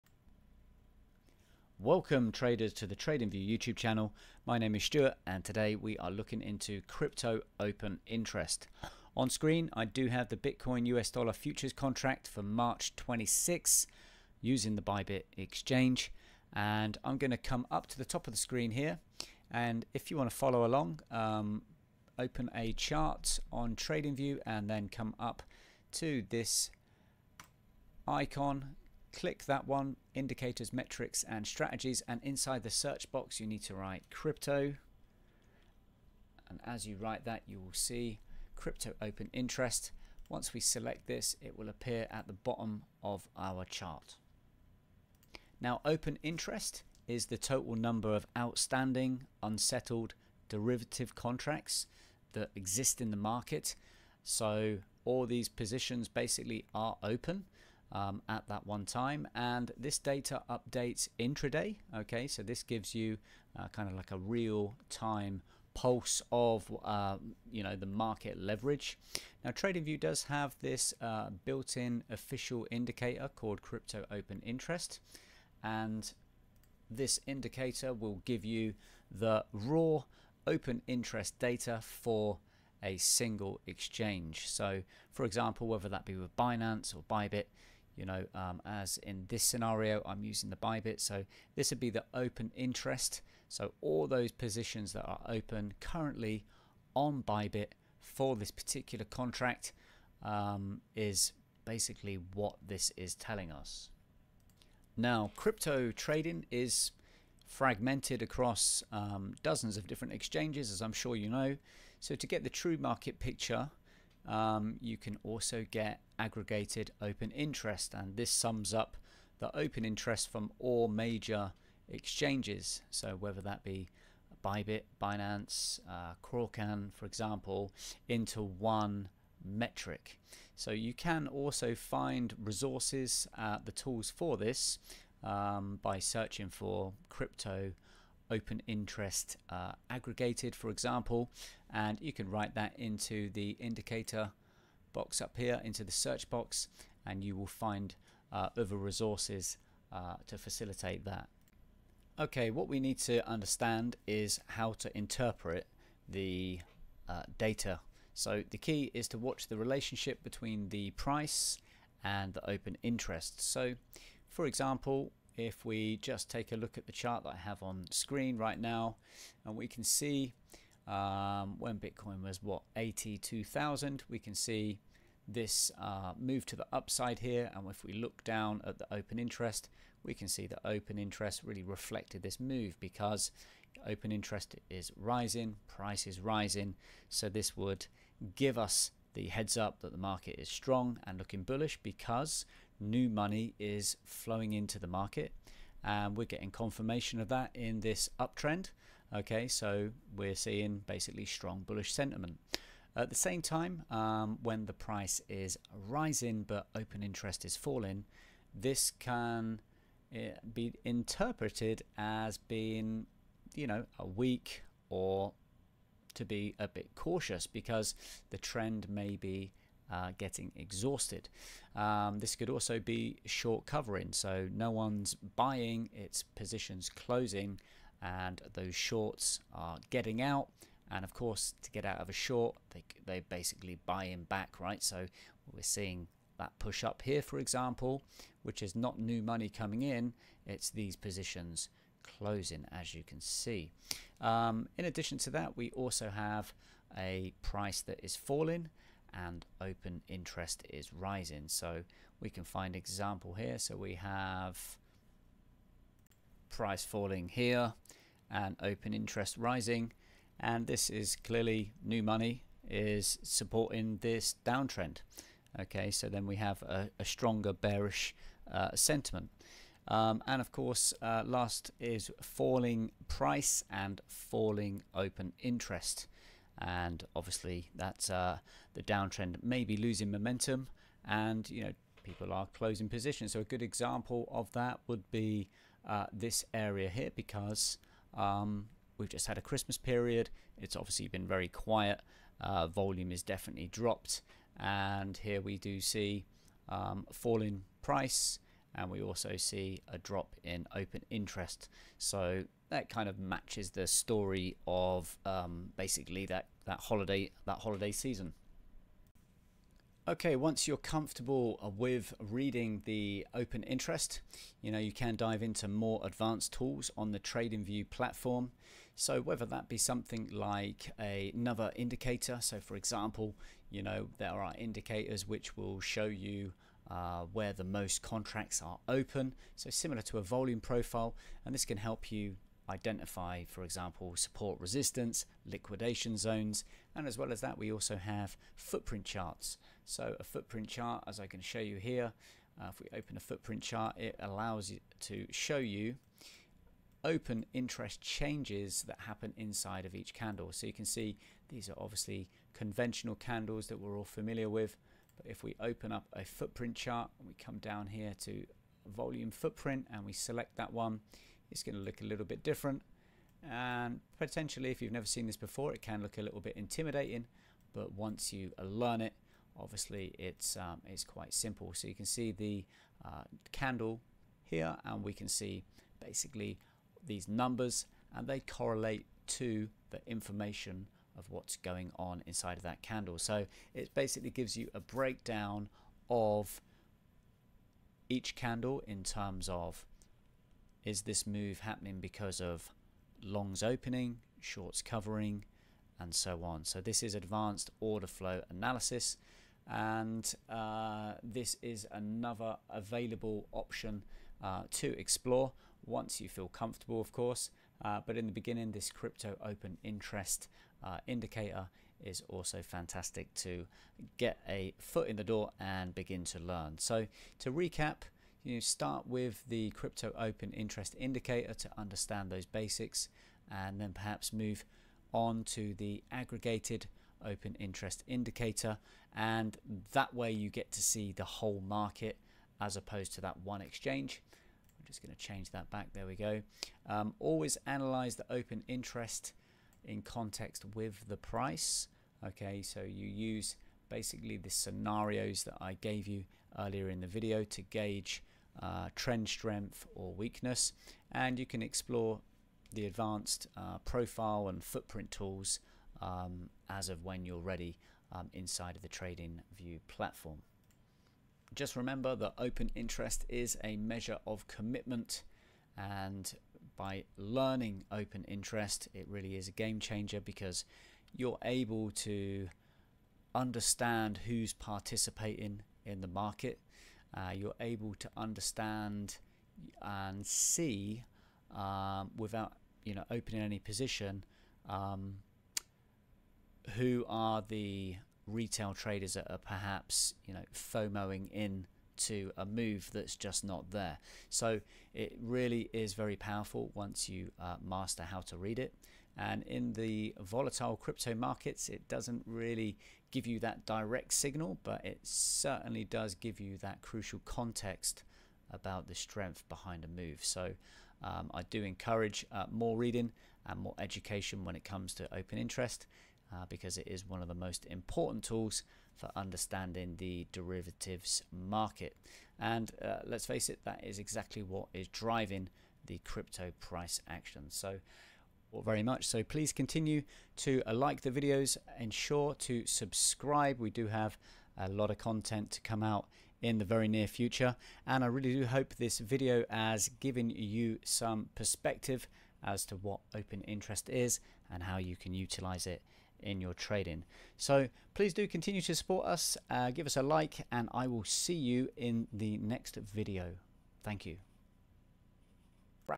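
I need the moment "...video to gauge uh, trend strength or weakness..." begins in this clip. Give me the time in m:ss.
7:27.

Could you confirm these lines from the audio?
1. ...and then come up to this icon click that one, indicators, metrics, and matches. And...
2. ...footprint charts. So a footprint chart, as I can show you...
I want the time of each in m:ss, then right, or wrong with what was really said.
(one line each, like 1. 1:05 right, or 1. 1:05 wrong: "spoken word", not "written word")
1. 0:24 wrong: "strategies", not "matches"
2. 5:38 right.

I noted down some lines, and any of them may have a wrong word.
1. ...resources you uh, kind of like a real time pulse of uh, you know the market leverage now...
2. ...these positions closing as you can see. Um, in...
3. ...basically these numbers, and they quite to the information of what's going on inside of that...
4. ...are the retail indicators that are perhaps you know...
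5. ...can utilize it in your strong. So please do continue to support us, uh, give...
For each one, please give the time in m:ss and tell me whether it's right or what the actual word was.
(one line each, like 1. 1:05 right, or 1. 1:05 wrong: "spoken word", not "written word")
1. 1:02 wrong: "gives", not "resources"
2. 4:00 right
3. 6:15 wrong: "correlate", not "quite"
4. 8:07 wrong: "traders", not "indicators"
5. 9:04 wrong: "trading", not "strong".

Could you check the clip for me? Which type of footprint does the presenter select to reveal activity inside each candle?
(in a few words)
volume footprint.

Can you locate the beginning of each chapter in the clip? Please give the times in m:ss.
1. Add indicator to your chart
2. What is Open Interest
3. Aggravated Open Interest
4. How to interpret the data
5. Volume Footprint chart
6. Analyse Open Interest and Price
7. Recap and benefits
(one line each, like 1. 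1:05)
1. 0:27
2. 0:50
3. 1:50
4. 2:38
5. 5:22
6. 7:20
7. 7:55.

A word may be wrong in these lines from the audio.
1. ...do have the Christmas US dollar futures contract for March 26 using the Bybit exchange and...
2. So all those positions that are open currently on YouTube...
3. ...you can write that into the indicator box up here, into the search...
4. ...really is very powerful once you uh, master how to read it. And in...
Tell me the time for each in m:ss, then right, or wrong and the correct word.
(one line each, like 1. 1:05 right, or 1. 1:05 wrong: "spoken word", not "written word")
1. 0:09 wrong: "Bitcoin", not "Christmas"
2. 1:33 wrong: "Bybit", not "YouTube"
3. 2:22 right
4. 8:15 right.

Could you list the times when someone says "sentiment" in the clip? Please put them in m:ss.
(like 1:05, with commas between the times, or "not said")
3:21, 4:28.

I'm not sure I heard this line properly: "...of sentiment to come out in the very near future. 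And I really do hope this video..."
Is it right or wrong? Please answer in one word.
wrong.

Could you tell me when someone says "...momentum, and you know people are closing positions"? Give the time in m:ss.
4:40.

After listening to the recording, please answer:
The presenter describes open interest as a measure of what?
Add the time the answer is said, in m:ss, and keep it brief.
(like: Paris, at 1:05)
commitment, at 7:44.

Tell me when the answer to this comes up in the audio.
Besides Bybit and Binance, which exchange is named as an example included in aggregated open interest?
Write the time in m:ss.
2:06.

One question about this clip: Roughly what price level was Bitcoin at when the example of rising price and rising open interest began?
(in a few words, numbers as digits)
82,000.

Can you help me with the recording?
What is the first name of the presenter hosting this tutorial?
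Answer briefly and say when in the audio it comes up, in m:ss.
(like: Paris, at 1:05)
Stuart, at 0:04.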